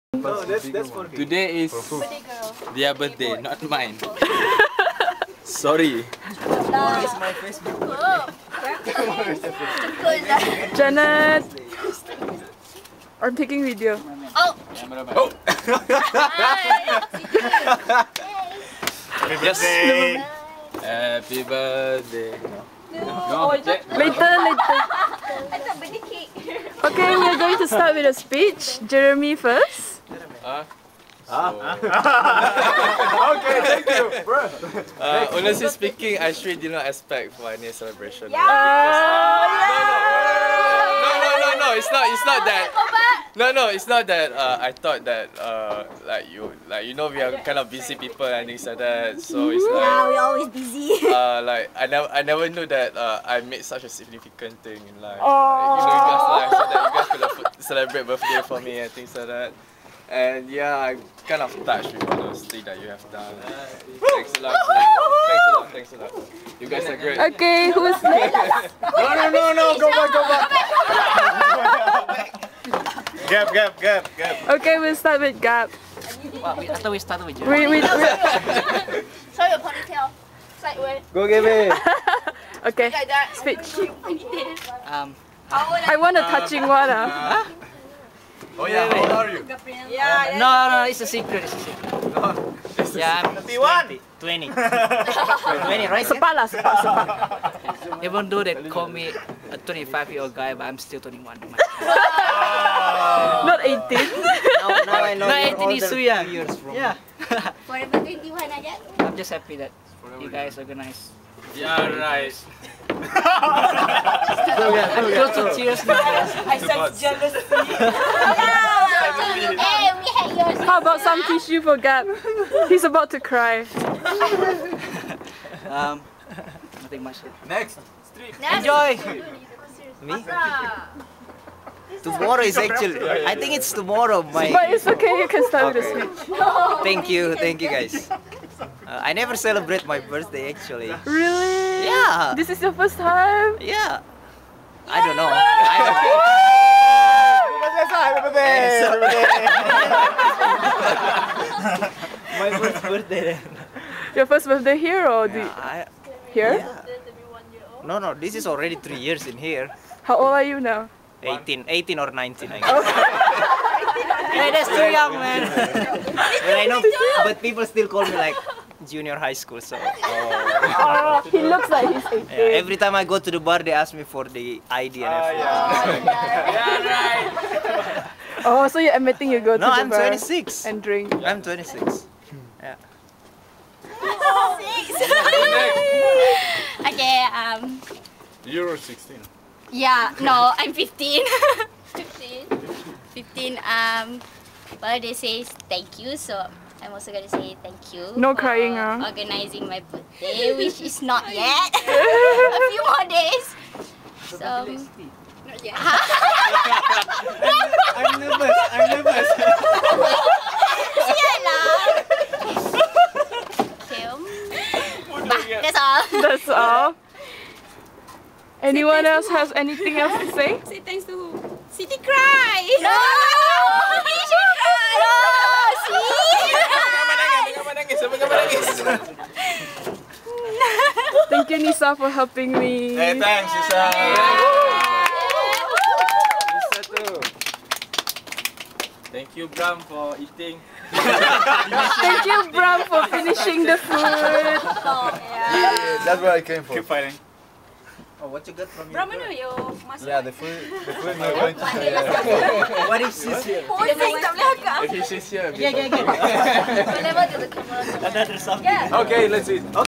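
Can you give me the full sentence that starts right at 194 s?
Well, they say thank you, so I'm also gonna say thank you.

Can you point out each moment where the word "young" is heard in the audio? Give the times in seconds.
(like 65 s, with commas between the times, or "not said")
105 s, 164 s.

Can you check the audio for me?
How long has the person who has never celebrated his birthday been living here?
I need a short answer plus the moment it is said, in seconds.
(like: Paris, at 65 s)
3 years, at 158 s.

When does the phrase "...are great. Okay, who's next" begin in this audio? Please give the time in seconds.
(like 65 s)
66 s.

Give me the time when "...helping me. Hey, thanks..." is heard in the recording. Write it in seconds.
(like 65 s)
232 s.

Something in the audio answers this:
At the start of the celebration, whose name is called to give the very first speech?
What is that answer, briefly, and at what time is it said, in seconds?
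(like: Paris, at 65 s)
Jeremi, at 28 s.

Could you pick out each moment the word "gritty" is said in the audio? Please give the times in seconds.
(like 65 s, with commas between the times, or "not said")
not said.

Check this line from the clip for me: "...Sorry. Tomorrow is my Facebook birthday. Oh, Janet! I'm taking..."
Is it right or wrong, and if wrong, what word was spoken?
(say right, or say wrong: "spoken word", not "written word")
right.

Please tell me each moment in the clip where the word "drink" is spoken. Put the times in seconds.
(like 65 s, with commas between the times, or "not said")
180 s.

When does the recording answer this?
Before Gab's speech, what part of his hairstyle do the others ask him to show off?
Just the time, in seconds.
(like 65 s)
79 s.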